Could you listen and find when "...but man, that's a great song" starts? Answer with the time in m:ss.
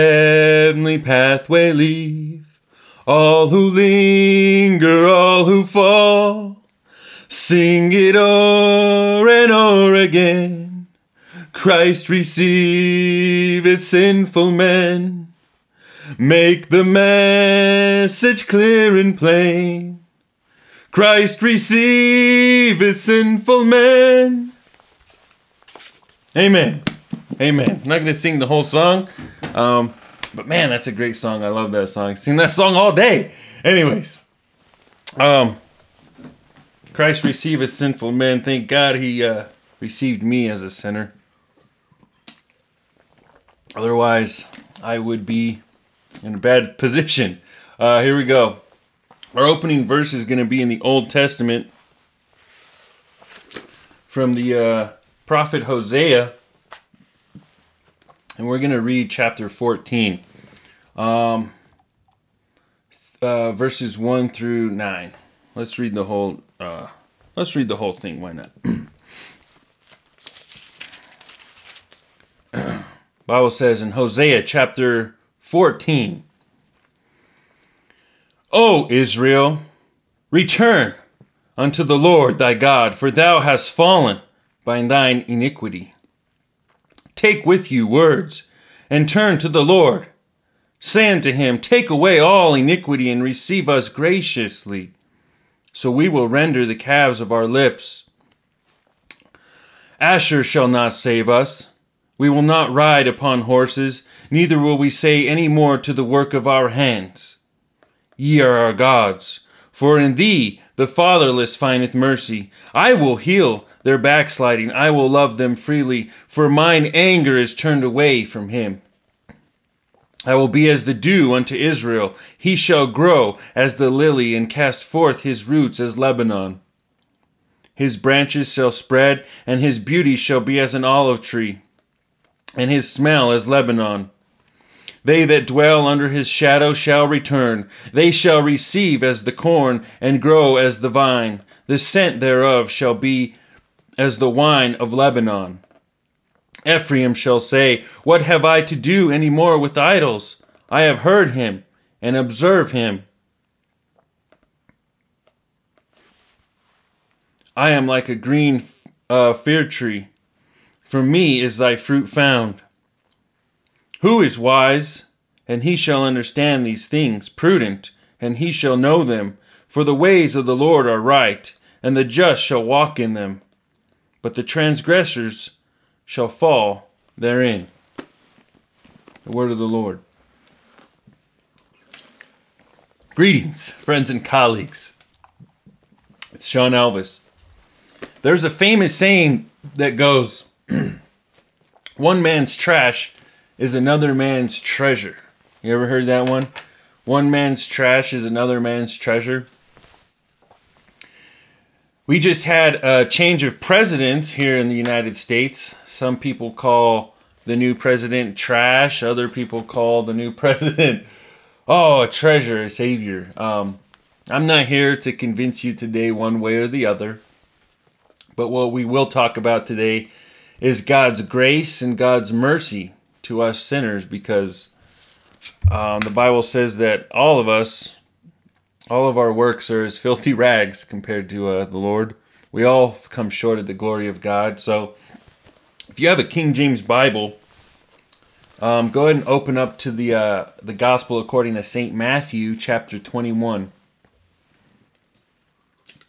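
0:30.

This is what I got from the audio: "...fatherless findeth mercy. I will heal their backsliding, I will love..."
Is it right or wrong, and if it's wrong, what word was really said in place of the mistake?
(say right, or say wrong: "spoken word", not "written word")
right.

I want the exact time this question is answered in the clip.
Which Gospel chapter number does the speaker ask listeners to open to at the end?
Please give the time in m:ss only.
4:02.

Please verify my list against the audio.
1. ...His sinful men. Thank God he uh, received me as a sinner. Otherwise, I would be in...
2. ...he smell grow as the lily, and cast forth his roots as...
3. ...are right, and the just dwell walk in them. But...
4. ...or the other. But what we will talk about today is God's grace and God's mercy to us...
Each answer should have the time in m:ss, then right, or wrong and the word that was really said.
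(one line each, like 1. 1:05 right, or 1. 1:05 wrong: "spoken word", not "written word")
1. 0:37 right
2. 2:02 wrong: "shall", not "smell"
3. 2:50 wrong: "shall", not "dwell"
4. 3:36 right.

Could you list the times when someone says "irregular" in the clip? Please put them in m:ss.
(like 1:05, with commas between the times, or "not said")
not said.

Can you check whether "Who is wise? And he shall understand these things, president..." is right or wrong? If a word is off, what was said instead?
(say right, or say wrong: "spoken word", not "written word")
wrong: "prudent", not "president".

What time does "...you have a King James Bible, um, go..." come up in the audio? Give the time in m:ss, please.
3:55.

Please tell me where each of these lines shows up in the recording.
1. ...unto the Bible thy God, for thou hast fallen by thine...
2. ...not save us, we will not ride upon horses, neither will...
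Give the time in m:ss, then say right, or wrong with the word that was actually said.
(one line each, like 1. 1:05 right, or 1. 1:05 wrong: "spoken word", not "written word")
1. 1:21 wrong: "Lord", not "Bible"
2. 1:40 right.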